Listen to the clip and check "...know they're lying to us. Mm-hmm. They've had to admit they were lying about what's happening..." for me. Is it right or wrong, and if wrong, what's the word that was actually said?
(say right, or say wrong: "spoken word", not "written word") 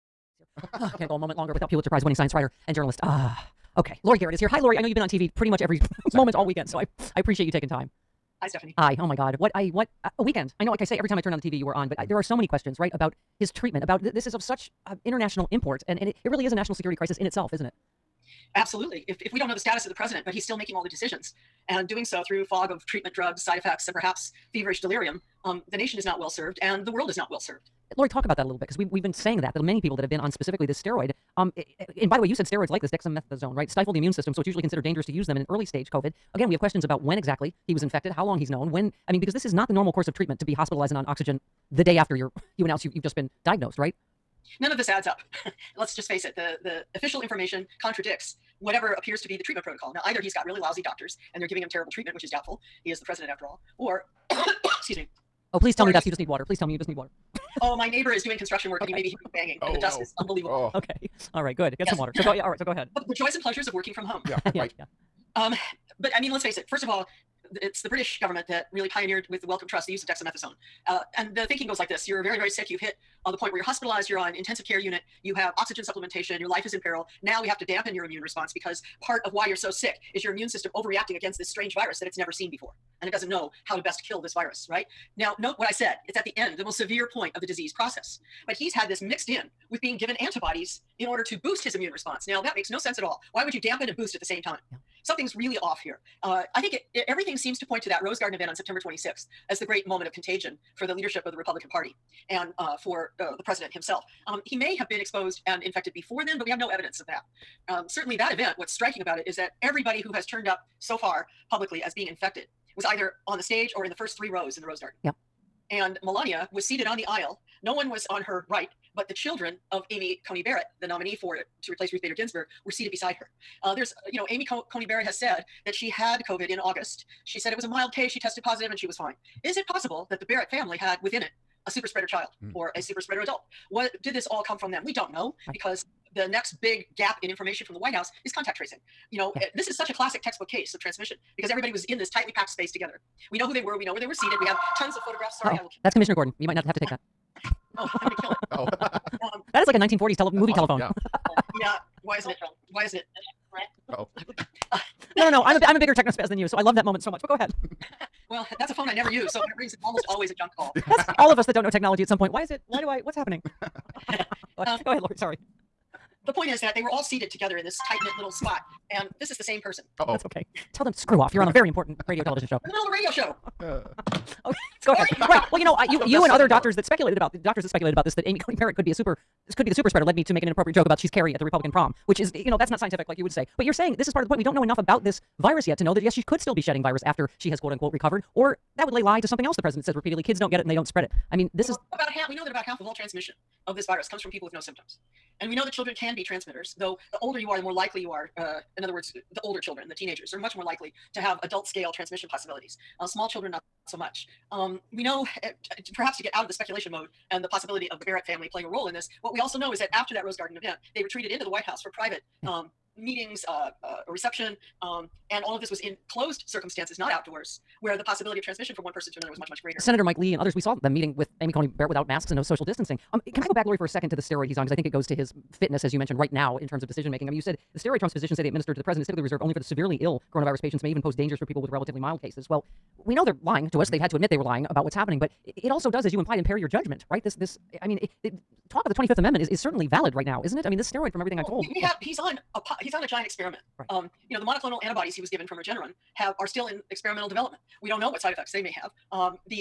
right.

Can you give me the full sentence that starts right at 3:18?
Uh, in other words, the older children, the teenagers, are much more likely to have adult scale transmission possibilities.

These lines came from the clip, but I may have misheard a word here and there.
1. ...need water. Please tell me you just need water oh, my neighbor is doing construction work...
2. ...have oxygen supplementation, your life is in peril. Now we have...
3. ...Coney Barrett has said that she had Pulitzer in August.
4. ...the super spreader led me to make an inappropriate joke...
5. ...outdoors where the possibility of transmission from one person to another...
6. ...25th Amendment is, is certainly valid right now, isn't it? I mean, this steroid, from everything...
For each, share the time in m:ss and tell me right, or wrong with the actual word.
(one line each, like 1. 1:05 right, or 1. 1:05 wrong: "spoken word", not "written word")
1. 0:56 right
2. 1:15 right
3. 2:04 wrong: "COVID", not "Pulitzer"
4. 2:59 right
5. 3:37 right
6. 3:58 right.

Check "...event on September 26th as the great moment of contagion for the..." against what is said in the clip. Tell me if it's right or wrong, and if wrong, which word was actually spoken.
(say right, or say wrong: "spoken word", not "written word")
right.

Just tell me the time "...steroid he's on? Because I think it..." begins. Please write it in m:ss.
3:44.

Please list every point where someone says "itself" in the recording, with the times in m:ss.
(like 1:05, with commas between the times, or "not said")
0:17.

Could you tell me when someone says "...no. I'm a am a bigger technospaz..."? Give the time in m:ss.
2:35.